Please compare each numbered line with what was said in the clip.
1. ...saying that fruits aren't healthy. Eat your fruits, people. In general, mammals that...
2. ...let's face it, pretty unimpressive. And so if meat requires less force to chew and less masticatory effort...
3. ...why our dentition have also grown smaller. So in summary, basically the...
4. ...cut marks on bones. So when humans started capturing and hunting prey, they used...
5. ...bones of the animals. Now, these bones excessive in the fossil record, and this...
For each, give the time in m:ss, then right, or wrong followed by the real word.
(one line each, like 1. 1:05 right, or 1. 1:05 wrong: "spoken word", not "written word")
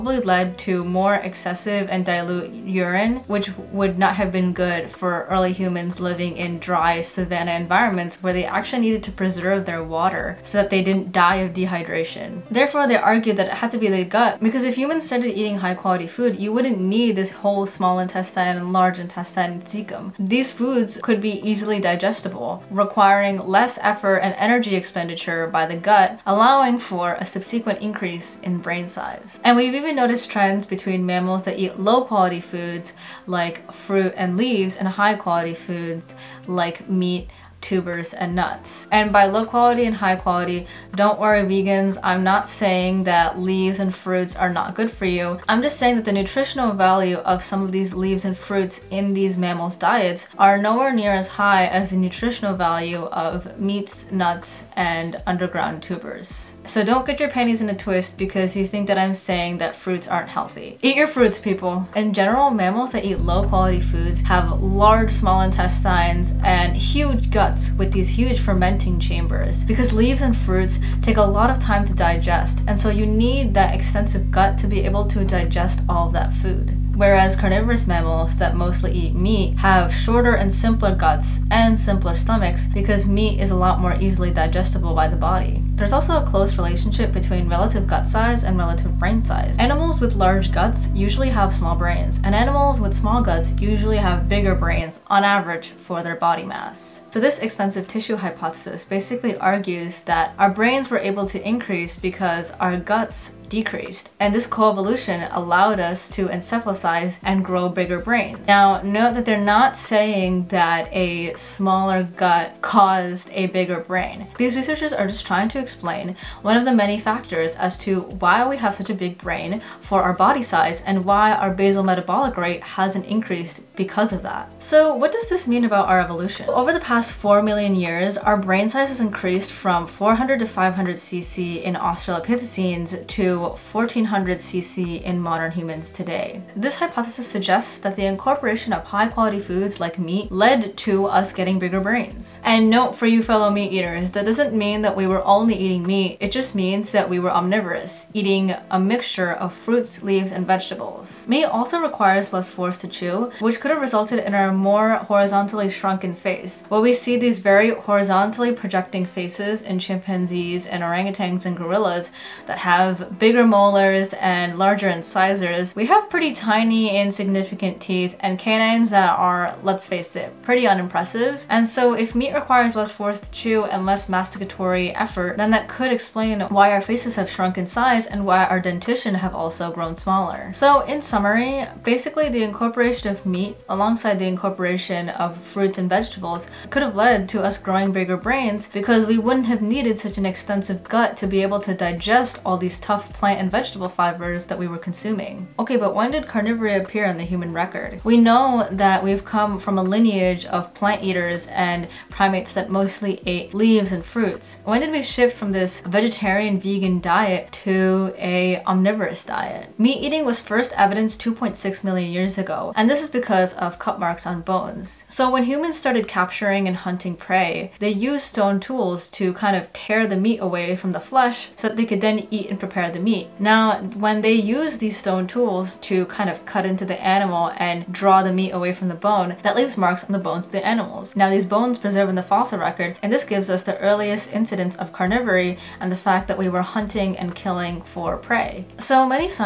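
1. 0:59 right
2. 2:49 right
3. 2:58 right
4. 3:33 right
5. 3:50 wrong: "preserve", not "excessive".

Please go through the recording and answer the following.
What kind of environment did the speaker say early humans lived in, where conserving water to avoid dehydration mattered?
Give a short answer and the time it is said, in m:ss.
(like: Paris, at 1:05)
Dry savanna, at 0:06.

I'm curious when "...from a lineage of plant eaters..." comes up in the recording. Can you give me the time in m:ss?
3:19.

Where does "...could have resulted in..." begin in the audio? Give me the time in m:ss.
2:33.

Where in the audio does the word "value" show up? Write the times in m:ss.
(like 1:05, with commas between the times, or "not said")
0:46, 0:52.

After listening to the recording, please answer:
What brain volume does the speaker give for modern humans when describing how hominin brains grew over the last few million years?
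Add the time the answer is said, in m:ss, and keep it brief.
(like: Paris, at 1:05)
1400 cc, at 2:13.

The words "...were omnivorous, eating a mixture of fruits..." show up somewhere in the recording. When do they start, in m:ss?
2:27.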